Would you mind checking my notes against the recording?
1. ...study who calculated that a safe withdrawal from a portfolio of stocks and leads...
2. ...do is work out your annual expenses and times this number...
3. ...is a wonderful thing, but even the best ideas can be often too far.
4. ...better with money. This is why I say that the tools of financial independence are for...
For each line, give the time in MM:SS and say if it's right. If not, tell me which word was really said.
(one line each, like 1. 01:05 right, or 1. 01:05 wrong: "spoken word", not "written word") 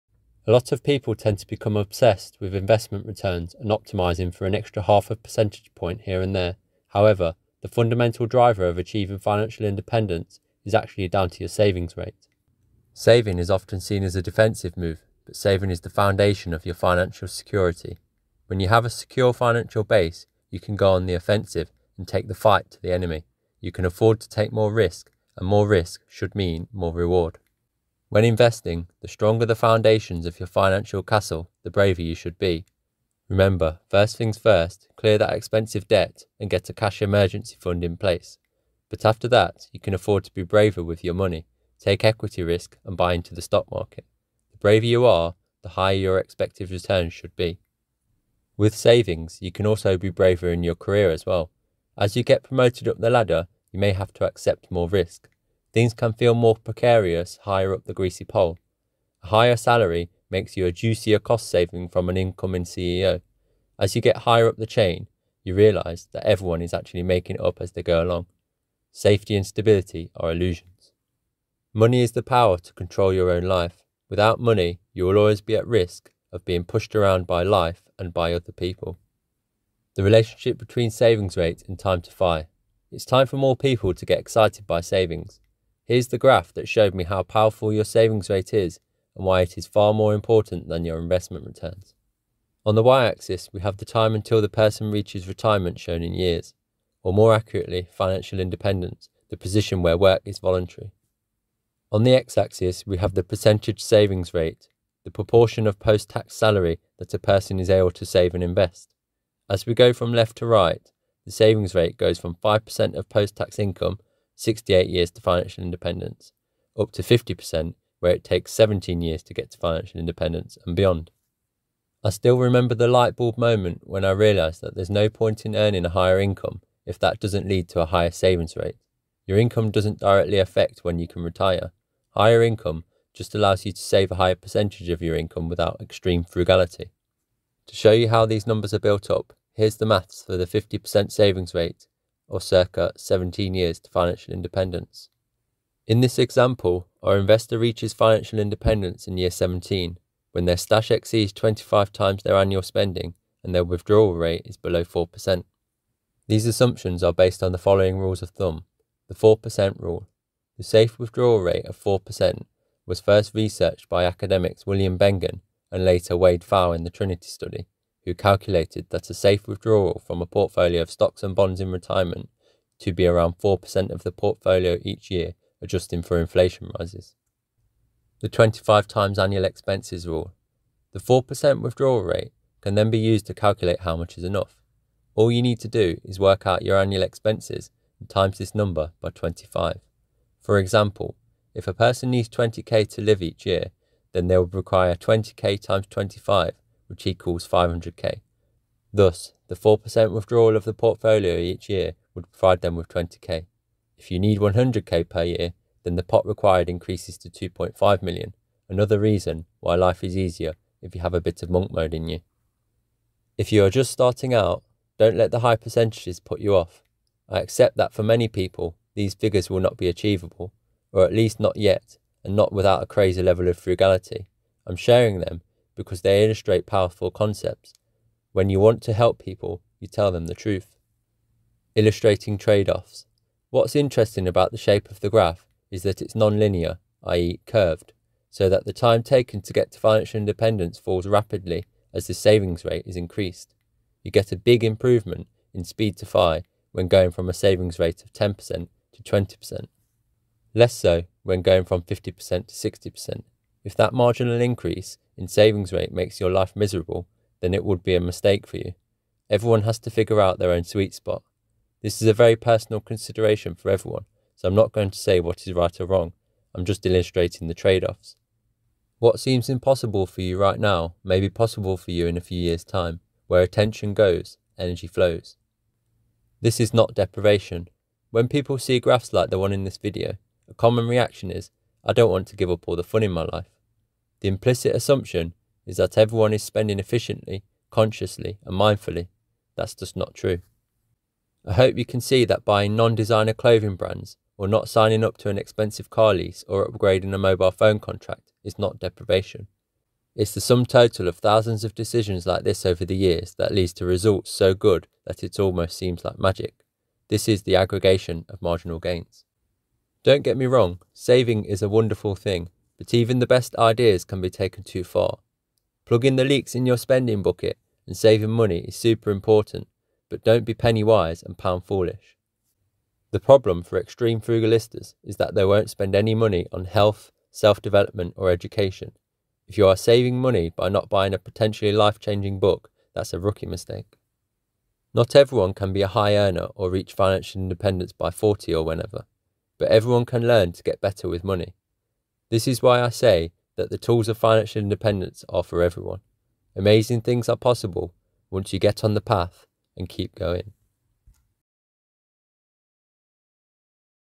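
1. 02:47 wrong: "bonds", not "leads"
2. 03:05 right
3. 05:11 wrong: "taken", not "often"
4. 05:40 right.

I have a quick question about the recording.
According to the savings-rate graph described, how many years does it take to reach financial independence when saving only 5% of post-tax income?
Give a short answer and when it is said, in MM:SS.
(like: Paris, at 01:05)
68 years, at 01:54.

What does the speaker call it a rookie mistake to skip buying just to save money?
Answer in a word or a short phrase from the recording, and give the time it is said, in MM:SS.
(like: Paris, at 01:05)
life changing book, at 05:31.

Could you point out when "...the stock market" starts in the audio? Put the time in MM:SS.
00:43.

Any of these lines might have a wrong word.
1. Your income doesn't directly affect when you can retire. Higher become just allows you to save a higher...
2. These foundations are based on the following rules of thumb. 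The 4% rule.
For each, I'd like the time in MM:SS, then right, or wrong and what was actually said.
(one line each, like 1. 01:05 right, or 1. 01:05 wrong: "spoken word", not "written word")
1. 02:09 wrong: "income", not "become"
2. 02:36 wrong: "assumptions", not "foundations".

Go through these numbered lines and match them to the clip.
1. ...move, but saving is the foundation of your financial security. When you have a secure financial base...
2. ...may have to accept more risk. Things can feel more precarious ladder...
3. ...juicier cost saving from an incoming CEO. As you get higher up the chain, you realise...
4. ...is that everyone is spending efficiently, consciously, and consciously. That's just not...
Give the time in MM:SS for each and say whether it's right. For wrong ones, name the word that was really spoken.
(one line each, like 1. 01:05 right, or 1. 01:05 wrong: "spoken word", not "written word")
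1. 00:14 right
2. 00:53 wrong: "higher", not "ladder"
3. 01:00 right
4. 04:45 wrong: "mindfully", not "consciously".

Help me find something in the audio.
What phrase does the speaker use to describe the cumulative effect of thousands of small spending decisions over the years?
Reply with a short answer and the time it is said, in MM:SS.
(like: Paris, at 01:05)
aggregation of marginal gains, at 05:07.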